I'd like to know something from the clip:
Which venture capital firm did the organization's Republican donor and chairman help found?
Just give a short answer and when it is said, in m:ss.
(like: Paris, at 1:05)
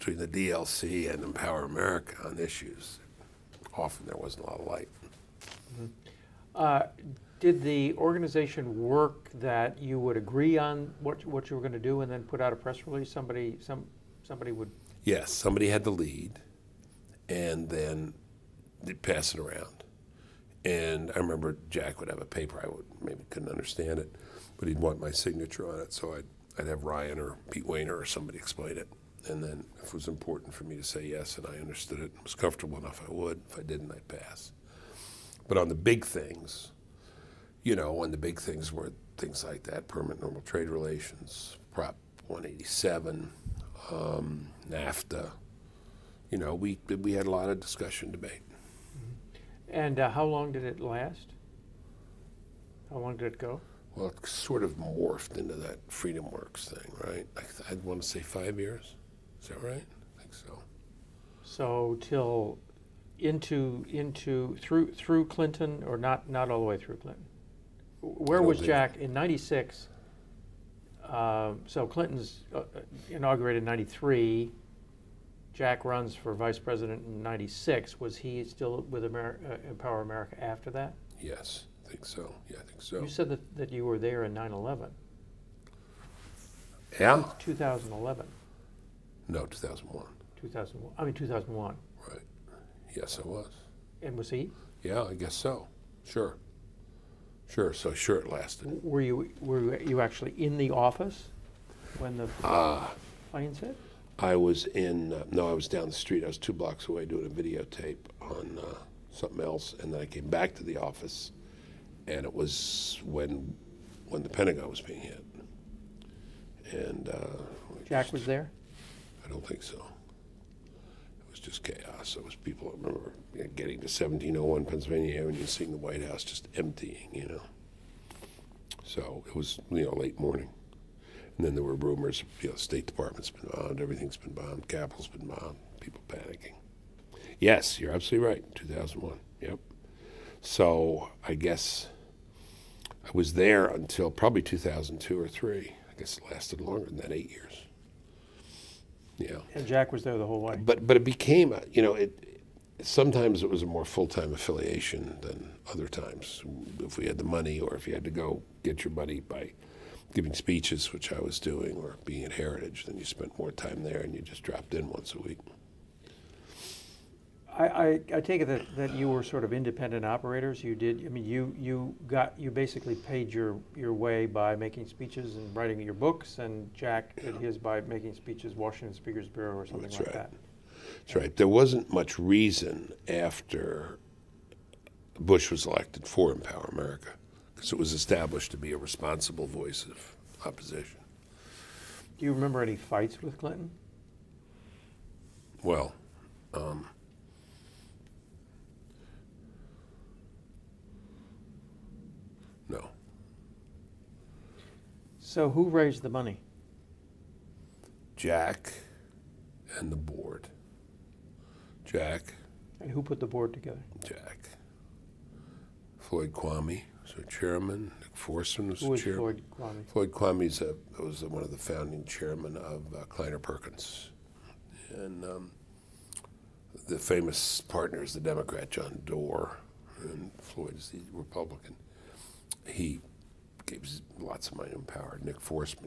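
Kleiner Perkins, at 3:43.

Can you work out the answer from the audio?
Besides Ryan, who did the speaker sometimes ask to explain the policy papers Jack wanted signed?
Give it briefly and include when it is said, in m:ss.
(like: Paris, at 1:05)
Pete Wehner, at 0:27.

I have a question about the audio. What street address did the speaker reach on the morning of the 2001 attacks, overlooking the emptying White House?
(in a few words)
1701 Pennsylvania Avenue.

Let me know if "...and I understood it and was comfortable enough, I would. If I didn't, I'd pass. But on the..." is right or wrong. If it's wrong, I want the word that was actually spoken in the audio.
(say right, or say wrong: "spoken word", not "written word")
right.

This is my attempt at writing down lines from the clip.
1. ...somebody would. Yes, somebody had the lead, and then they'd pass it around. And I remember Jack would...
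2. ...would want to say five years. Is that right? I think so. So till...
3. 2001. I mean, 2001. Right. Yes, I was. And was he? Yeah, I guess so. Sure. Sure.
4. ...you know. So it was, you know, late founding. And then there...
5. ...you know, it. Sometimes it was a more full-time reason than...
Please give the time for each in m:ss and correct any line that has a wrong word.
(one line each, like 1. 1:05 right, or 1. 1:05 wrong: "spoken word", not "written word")
1. 0:14 right
2. 0:57 right
3. 1:30 right
4. 2:07 wrong: "morning", not "founding"
5. 2:31 wrong: "affiliation", not "reason".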